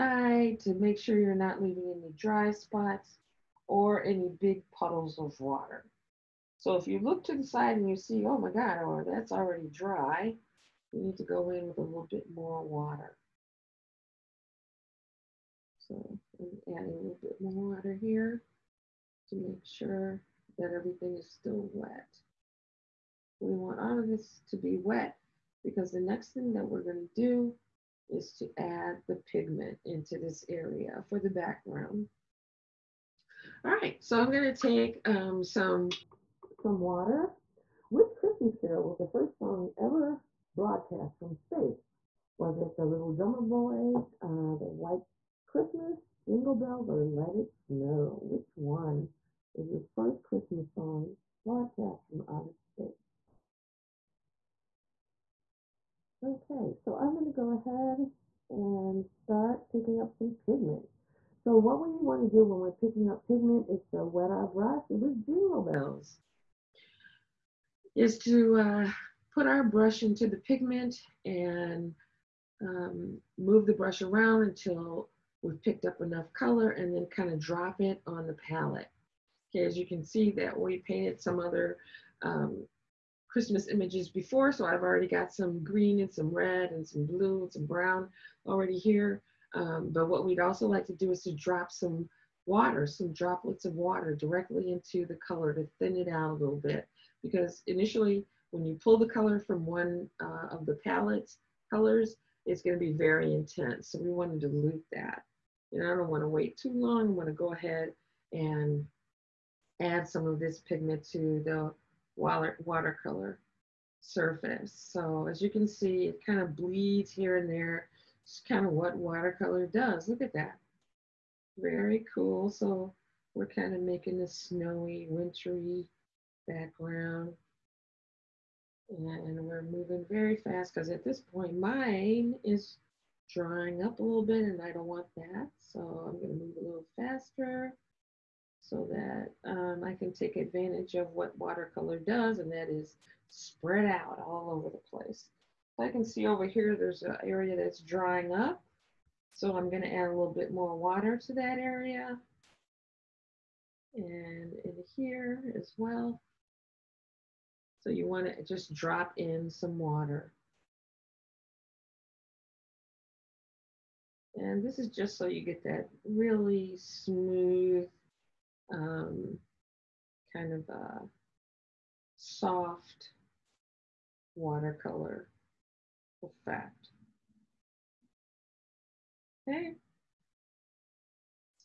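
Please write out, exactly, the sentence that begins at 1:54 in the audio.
So as you can see, it kind of bleeds here and there.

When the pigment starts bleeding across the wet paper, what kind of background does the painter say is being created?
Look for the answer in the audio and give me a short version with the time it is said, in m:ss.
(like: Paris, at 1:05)
Snowy, wintry background, at 2:04.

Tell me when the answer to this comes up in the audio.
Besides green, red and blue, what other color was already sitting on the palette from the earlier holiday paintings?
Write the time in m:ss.
1:27.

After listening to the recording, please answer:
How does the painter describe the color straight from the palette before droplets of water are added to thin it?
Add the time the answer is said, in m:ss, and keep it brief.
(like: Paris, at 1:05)
Very intense, at 1:42.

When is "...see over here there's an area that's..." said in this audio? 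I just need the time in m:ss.
2:26.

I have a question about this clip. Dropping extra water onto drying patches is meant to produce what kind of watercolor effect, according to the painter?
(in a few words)
Soft watercolor effect.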